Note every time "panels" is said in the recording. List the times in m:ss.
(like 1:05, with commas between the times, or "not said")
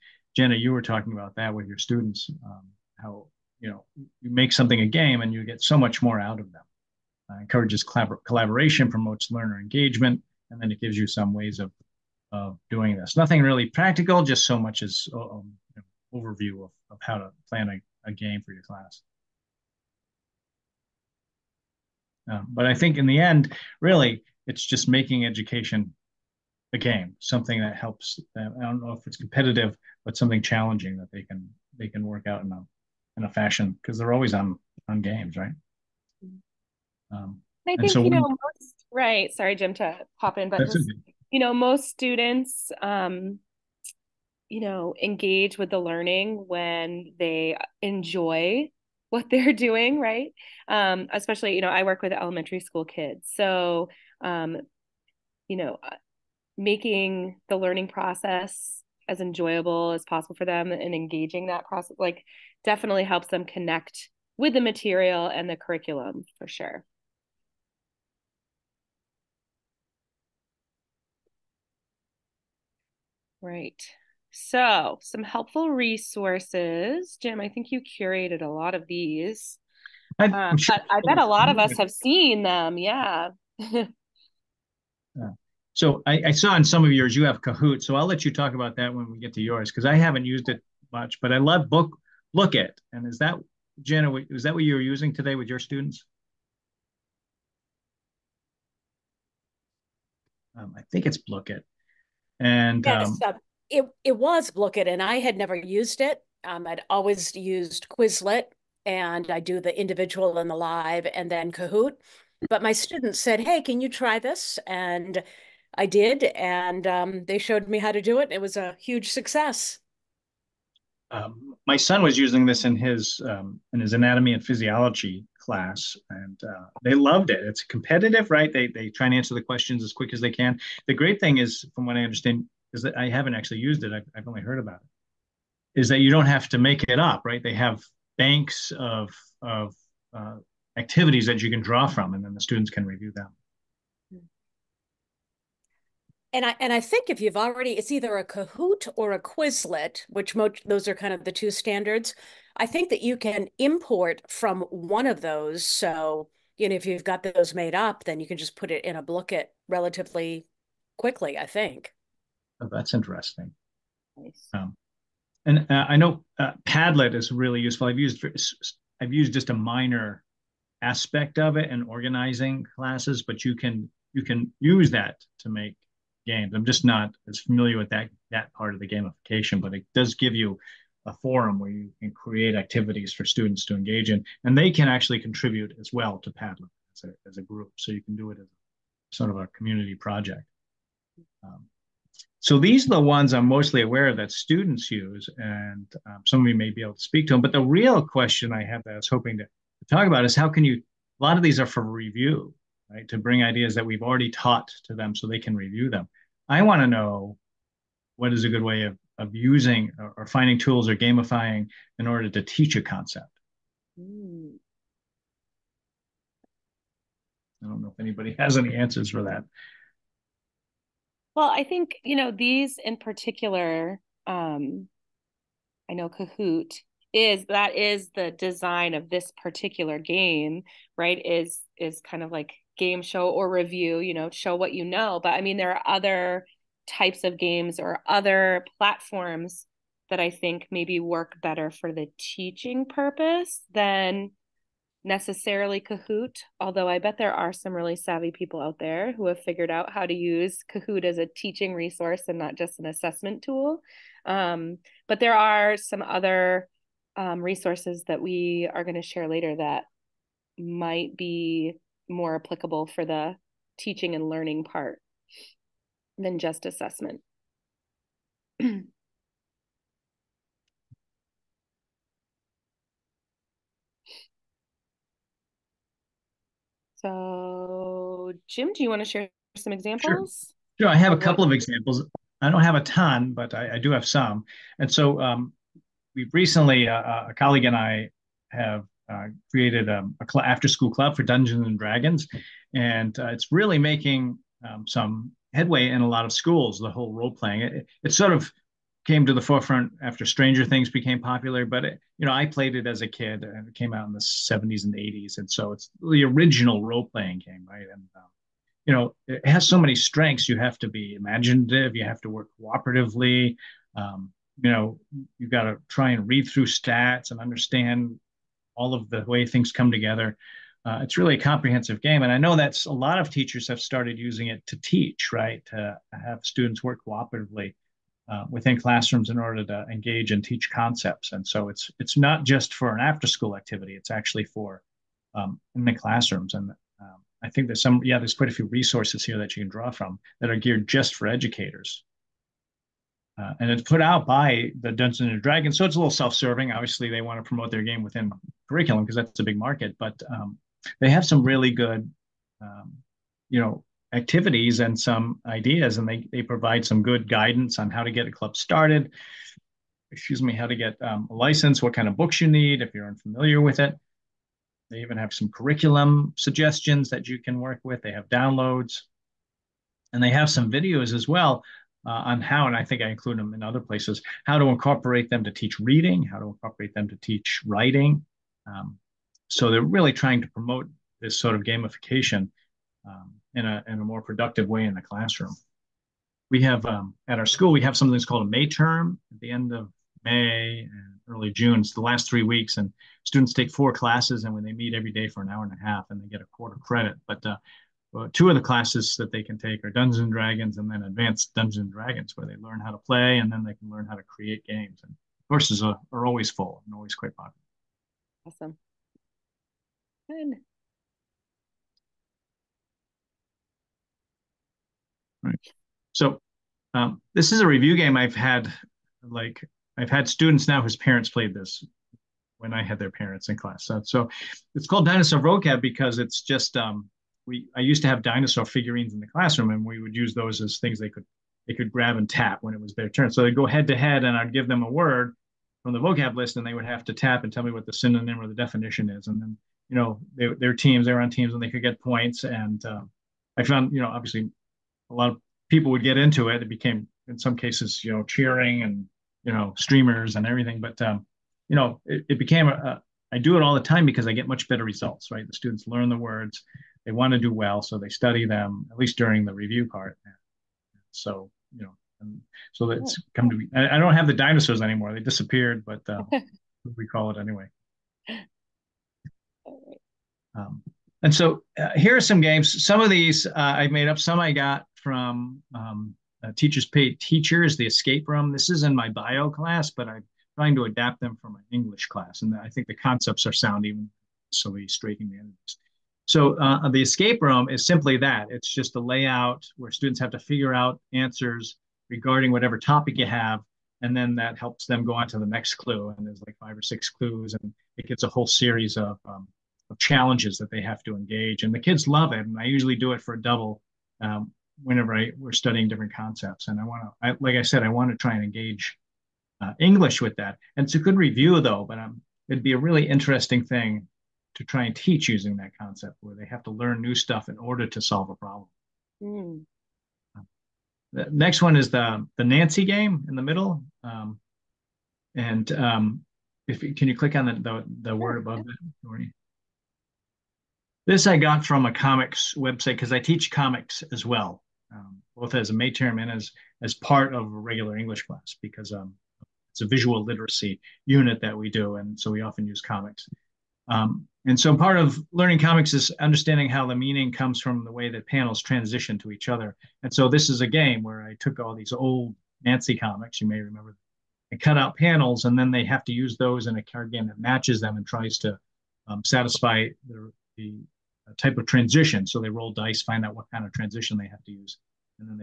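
9:08, 9:14.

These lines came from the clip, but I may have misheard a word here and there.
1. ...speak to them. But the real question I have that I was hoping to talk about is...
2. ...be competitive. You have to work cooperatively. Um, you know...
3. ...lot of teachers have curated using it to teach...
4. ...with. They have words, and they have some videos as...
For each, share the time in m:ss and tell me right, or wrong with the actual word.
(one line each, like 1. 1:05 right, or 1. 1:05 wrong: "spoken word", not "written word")
1. 3:16 right
2. 5:10 wrong: "imaginative", not "competitive"
3. 5:22 wrong: "started", not "curated"
4. 6:07 wrong: "downloads", not "words".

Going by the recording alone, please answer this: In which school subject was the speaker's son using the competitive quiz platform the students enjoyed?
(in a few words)
anatomy and physiology.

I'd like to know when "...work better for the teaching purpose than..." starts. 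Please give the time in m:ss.
4:00.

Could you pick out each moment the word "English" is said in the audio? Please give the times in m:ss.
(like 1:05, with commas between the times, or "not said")
8:01, 8:29, 8:57.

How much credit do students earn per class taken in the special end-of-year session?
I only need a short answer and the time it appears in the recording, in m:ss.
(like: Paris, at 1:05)
a quarter credit, at 6:36.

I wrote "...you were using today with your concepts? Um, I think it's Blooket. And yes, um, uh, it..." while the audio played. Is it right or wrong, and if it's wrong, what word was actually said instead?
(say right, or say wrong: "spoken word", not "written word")
wrong: "students", not "concepts".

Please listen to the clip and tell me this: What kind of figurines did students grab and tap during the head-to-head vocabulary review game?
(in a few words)
dinosaur figurines.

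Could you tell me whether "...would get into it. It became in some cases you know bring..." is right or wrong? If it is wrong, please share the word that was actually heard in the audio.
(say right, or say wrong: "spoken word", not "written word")
wrong: "cheering", not "bring".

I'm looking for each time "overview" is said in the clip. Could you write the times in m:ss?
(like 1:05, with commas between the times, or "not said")
0:16.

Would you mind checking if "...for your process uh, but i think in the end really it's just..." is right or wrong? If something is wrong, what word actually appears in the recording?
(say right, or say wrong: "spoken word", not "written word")
wrong: "class", not "process".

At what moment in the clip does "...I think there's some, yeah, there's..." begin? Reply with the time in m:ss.
5:37.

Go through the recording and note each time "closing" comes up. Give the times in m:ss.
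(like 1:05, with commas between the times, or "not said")
not said.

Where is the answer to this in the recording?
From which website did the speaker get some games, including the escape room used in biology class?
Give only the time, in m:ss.
7:56.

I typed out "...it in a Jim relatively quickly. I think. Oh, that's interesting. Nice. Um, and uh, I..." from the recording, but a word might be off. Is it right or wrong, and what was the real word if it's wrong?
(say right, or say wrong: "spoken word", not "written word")
wrong: "Blooket", not "Jim".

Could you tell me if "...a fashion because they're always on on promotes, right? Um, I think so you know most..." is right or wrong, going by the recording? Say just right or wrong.
wrong.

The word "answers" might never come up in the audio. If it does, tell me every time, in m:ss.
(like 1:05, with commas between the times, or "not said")
2:09, 3:38, 8:11.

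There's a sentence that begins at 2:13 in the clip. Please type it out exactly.
I've, I've only heard about it.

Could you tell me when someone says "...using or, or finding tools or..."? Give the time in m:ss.
3:29.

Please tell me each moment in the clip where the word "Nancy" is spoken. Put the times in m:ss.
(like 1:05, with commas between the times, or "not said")
8:42, 9:12.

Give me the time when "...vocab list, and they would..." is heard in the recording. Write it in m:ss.
7:15.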